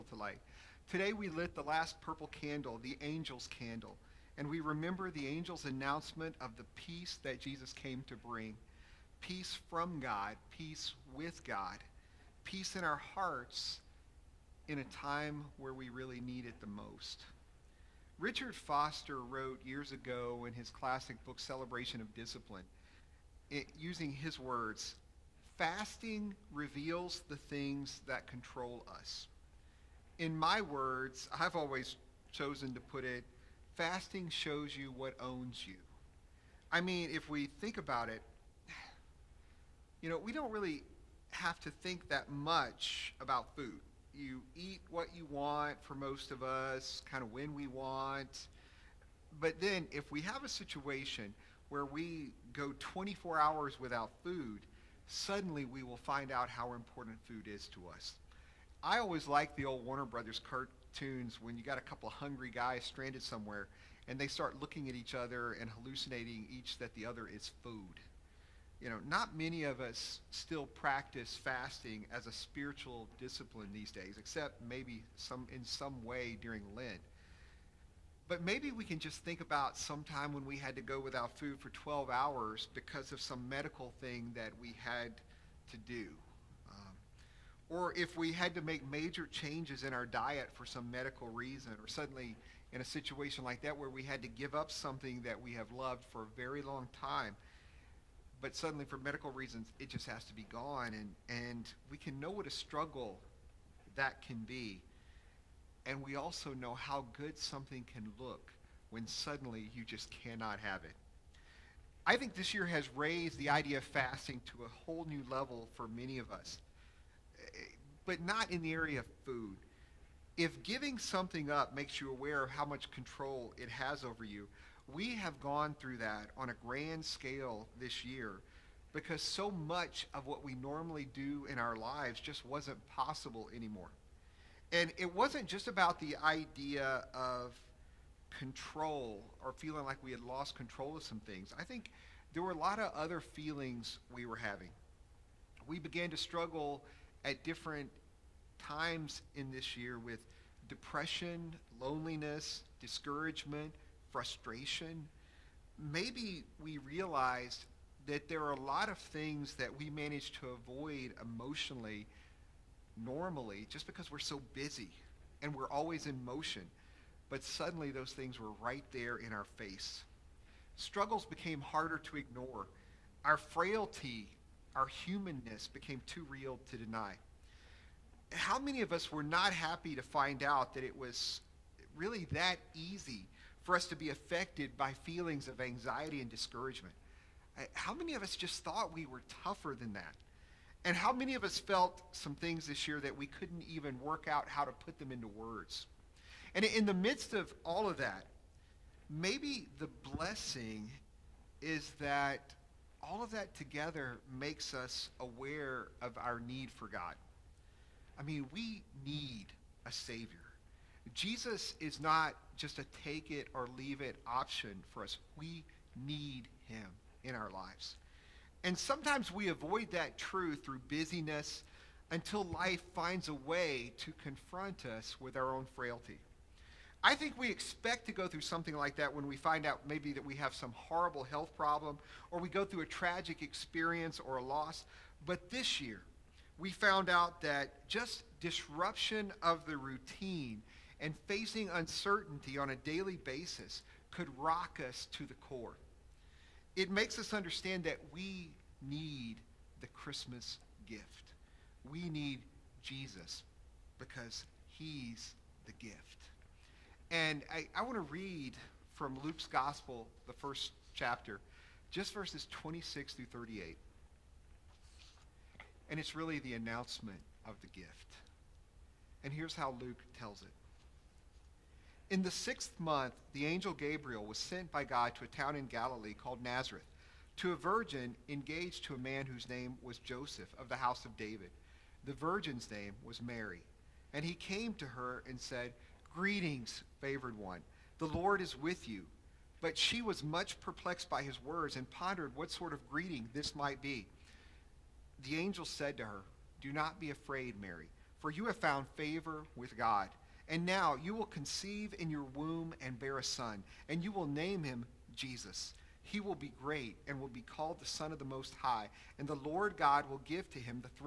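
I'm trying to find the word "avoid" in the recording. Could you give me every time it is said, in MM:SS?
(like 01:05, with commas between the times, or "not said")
02:40, 03:39.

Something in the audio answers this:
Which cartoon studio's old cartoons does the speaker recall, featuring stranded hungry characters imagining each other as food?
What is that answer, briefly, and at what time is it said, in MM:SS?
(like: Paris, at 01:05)
Warner Brothers, at 00:59.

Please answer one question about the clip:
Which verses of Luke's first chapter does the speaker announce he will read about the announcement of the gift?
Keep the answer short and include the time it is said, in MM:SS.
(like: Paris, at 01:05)
26 through 38, at 04:22.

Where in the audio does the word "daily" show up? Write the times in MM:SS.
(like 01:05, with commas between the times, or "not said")
04:02.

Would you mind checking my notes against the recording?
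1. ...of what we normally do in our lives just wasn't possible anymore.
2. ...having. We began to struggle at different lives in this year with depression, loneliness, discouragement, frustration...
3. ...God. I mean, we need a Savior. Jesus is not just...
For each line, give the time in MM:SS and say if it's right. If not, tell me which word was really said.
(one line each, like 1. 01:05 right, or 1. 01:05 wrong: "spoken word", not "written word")
1. 02:10 right
2. 02:24 wrong: "times", not "lives"
3. 03:26 right.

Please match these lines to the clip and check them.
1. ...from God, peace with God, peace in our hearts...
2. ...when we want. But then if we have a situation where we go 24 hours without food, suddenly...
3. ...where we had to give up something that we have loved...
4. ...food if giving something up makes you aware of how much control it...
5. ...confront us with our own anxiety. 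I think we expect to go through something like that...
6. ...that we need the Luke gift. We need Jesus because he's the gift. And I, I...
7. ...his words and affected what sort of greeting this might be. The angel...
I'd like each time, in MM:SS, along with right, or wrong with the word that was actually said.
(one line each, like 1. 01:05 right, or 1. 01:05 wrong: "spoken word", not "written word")
1. 00:09 right
2. 00:47 right
3. 01:33 right
4. 01:59 right
5. 03:44 wrong: "frailty", not "anxiety"
6. 04:07 wrong: "Christmas", not "Luke"
7. 04:51 wrong: "pondered", not "affected".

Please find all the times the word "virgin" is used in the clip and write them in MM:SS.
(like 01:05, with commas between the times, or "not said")
04:37, 04:42.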